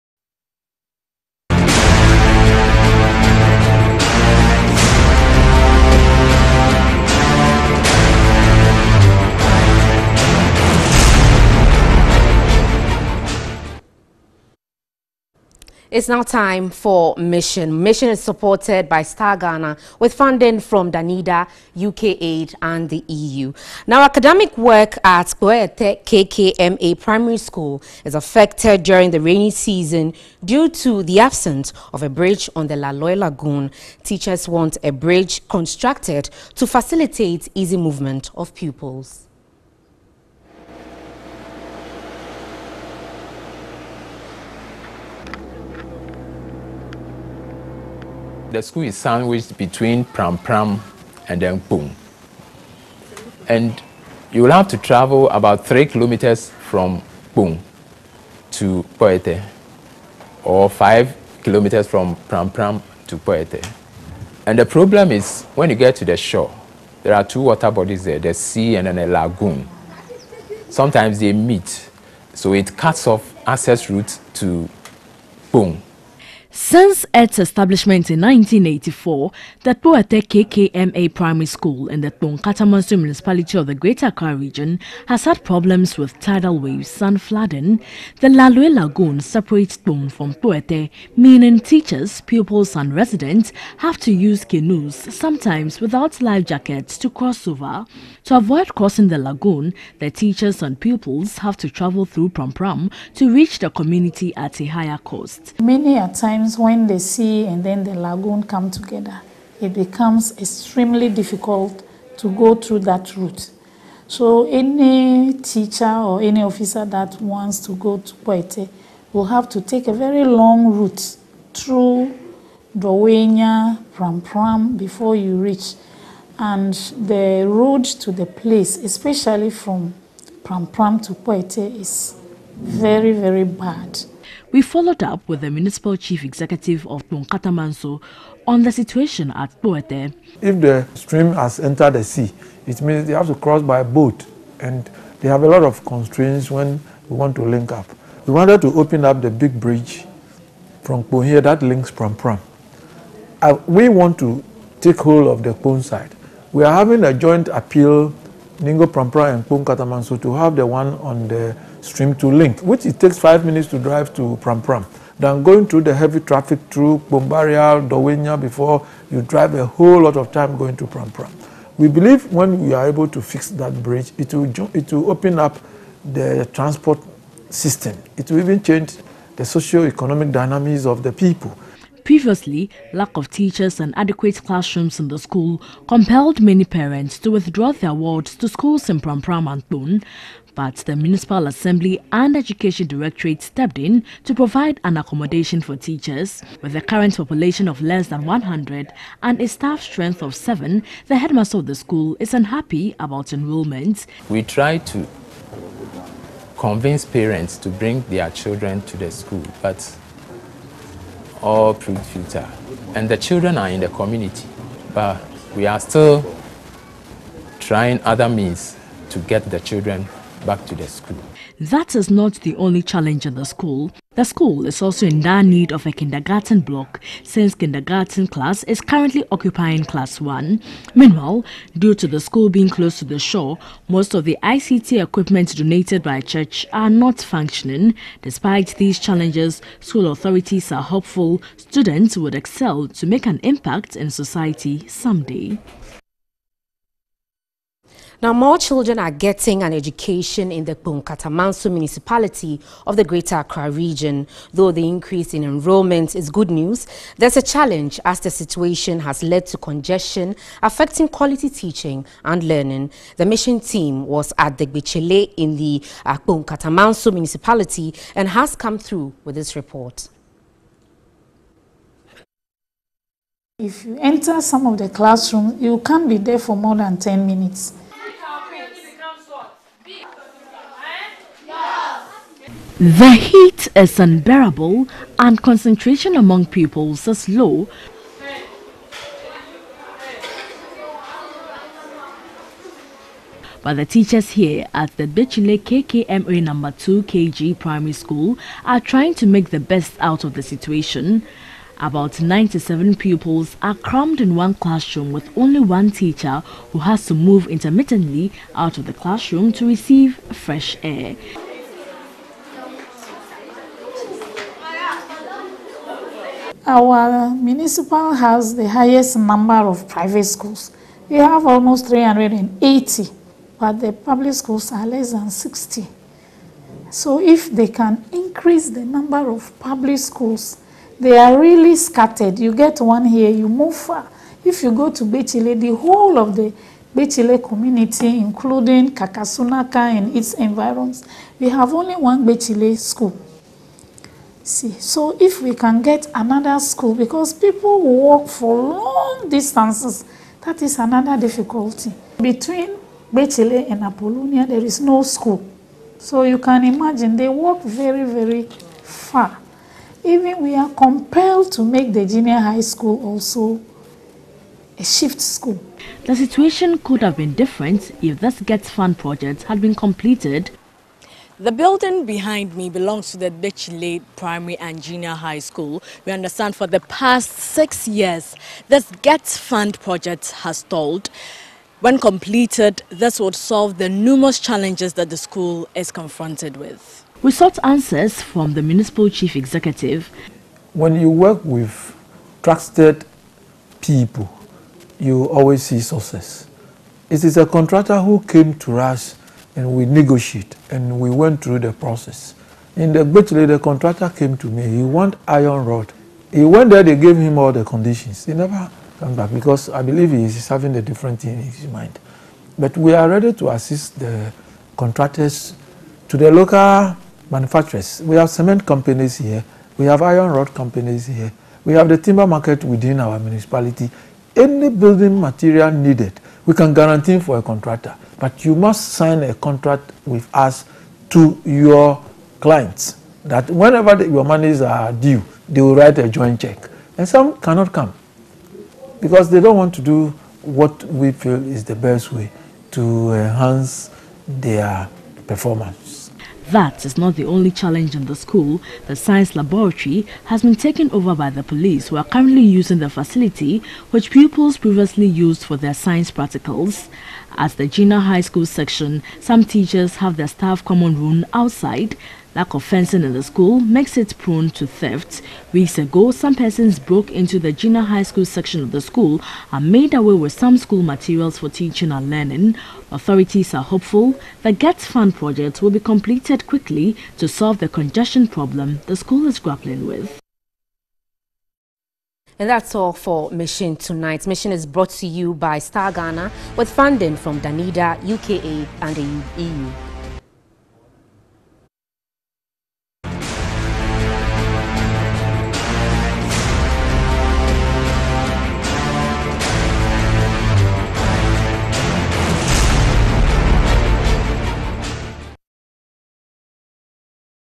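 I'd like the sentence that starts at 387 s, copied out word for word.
We sought answers from the Municipal Chief Executive.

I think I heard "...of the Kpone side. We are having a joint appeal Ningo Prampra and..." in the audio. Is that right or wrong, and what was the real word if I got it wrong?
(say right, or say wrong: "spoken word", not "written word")
right.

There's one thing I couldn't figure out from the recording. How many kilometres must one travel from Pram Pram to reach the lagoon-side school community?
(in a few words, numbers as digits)
5 kilometres.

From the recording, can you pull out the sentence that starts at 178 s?
It will even change the socio-economic dynamics of the people.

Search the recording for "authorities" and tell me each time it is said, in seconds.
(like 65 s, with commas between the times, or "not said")
240 s, 472 s.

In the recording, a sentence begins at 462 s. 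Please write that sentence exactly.
Lack of fencing in the school makes it prone to theft.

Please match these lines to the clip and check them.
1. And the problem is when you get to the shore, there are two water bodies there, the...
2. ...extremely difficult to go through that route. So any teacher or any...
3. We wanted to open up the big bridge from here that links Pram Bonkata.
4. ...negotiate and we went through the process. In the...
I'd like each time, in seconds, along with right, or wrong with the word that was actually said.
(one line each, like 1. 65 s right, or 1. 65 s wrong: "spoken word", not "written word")
1. 64 s right
2. 110 s right
3. 148 s wrong: "Pram", not "Bonkata"
4. 399 s right.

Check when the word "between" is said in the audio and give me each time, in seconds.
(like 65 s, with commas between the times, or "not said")
49 s, 352 s.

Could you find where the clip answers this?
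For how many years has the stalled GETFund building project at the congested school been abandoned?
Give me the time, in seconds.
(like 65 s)
377 s.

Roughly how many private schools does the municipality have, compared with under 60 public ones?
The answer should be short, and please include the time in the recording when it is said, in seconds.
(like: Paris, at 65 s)
380, at 321 s.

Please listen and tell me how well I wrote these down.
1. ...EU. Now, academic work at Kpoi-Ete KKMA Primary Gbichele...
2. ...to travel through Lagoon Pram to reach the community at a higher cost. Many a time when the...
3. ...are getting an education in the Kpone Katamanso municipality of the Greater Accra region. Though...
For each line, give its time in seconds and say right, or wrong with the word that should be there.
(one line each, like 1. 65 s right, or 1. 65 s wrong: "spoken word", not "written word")
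1. 23 s wrong: "School", not "Gbichele"
2. 101 s wrong: "Pram", not "Lagoon"
3. 248 s right.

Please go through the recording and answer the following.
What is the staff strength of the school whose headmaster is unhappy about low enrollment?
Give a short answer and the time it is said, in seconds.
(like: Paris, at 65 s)
7, at 200 s.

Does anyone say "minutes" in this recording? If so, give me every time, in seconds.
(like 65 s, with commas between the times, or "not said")
163 s, 277 s.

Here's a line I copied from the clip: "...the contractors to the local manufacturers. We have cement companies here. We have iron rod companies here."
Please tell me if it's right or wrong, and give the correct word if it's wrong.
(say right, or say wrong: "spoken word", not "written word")
right.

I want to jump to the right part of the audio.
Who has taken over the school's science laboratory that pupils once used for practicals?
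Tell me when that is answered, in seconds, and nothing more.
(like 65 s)
451 s.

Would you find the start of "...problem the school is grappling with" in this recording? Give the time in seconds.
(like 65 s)
478 s.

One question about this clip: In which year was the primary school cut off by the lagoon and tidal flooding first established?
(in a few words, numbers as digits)
1984.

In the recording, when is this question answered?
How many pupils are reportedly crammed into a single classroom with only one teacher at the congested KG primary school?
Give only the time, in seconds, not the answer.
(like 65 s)
302 s.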